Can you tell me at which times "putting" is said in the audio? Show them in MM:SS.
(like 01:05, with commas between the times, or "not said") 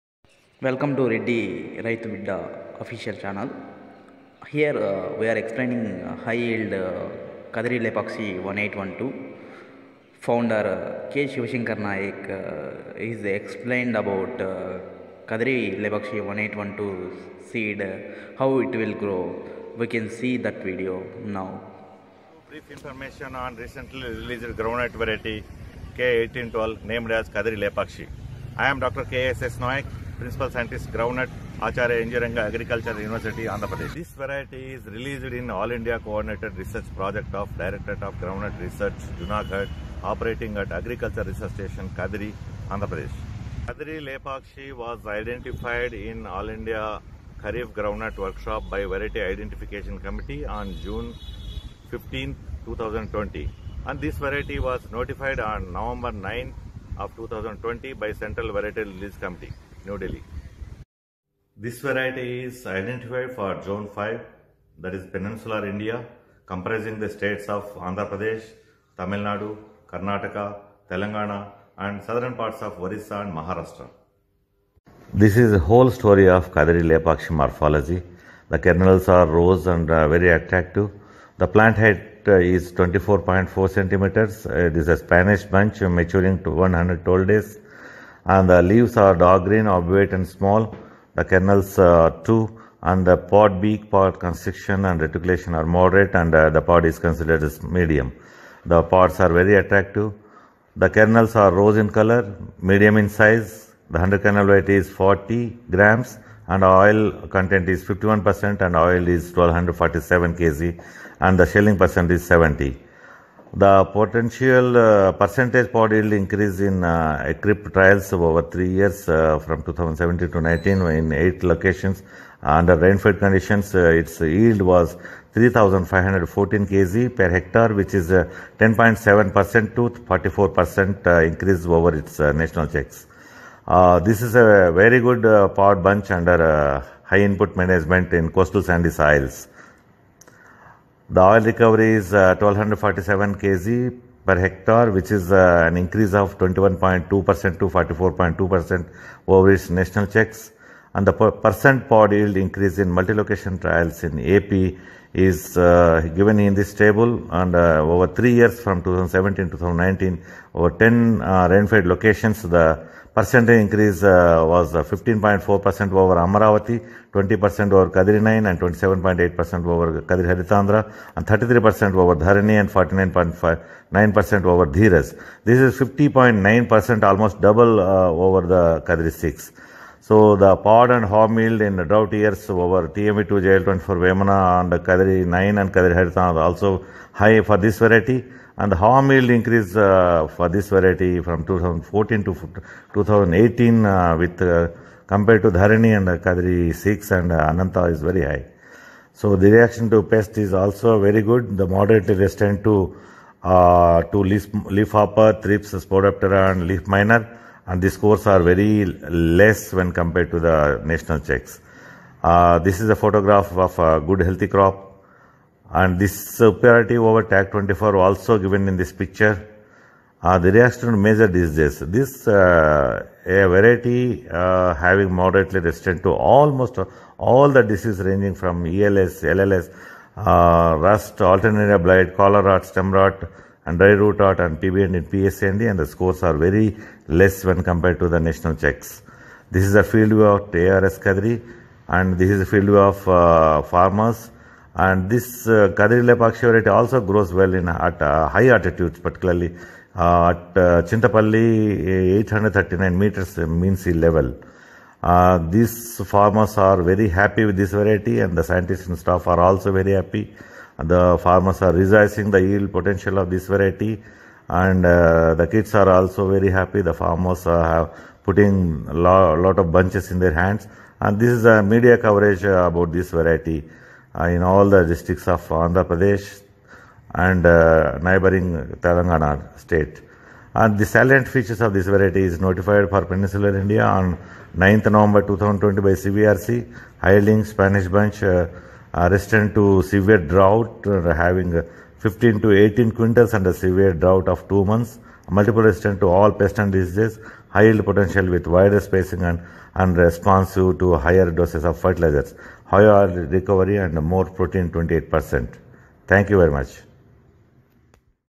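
04:28.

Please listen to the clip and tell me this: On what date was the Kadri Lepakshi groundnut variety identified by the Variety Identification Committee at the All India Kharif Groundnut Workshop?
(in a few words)
June 15, 2020.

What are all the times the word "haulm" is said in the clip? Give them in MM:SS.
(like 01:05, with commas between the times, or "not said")
03:01, 03:08.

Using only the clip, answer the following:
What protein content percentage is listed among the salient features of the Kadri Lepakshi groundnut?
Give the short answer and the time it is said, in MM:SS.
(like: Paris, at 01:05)
28%, at 05:04.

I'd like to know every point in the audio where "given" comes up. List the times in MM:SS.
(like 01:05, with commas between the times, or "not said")
02:36, 03:38.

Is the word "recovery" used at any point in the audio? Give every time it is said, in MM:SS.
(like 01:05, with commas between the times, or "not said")
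02:21, 05:03.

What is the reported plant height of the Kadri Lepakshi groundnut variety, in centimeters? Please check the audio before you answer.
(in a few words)
24.4 centimeters.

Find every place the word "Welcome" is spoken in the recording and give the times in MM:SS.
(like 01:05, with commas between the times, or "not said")
00:00.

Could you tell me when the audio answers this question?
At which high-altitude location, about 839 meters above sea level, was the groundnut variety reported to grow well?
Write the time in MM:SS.
04:10.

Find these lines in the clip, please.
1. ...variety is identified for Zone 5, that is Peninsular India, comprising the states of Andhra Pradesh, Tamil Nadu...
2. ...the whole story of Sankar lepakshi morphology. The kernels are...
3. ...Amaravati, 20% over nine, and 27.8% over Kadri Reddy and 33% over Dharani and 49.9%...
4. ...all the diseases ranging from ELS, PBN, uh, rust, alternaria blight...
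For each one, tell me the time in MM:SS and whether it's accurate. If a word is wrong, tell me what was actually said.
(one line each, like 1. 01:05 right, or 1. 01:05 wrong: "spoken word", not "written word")
1. 01:01 right
2. 01:15 wrong: "Kadiri", not "Sankar"
3. 02:46 wrong: "Harithandhra", not "Reddy"
4. 03:47 wrong: "LLS", not "PBN".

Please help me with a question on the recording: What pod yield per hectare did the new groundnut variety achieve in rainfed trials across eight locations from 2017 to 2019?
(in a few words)
3,514 kg per hectare.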